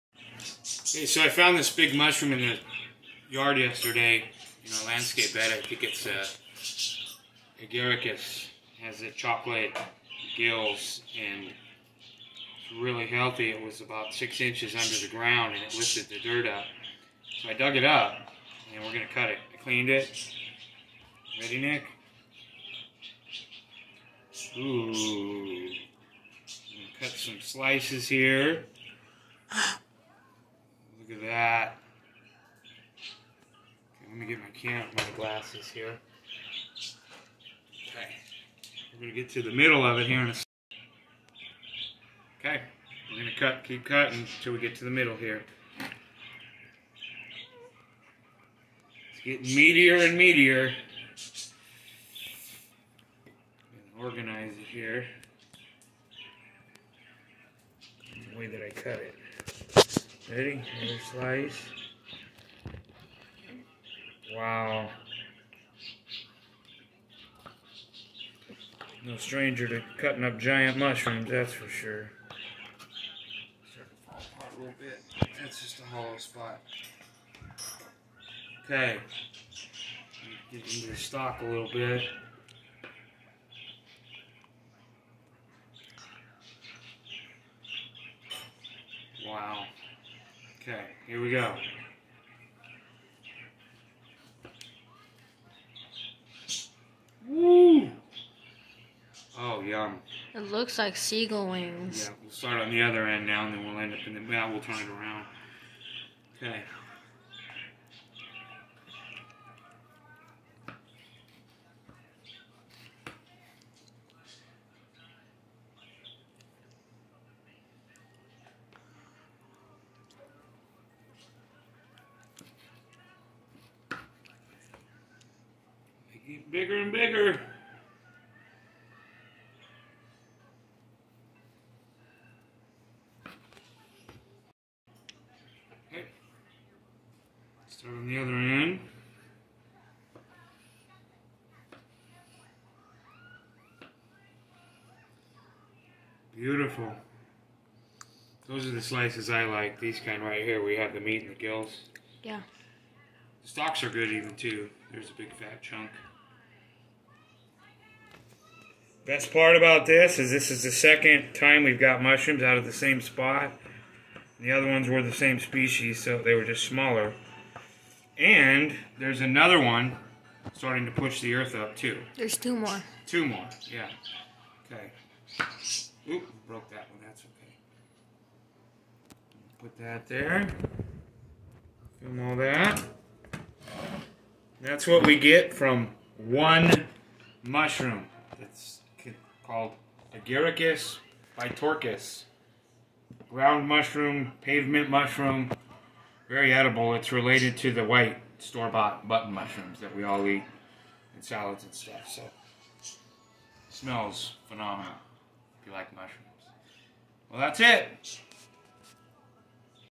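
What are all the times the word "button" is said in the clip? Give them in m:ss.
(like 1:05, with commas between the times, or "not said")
3:19.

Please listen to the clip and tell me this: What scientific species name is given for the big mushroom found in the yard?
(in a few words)
Agaricus bitorquis.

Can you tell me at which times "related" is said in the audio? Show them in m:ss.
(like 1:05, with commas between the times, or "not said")
3:17.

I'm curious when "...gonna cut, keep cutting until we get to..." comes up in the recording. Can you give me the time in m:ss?
0:43.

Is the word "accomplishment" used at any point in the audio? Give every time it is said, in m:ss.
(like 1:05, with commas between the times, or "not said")
not said.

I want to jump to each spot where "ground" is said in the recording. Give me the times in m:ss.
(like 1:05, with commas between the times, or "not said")
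0:15, 3:13.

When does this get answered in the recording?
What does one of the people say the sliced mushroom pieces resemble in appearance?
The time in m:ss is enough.
1:40.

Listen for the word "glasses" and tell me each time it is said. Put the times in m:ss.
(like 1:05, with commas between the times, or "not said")
0:35.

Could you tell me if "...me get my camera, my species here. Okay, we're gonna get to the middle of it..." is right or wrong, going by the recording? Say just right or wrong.
wrong.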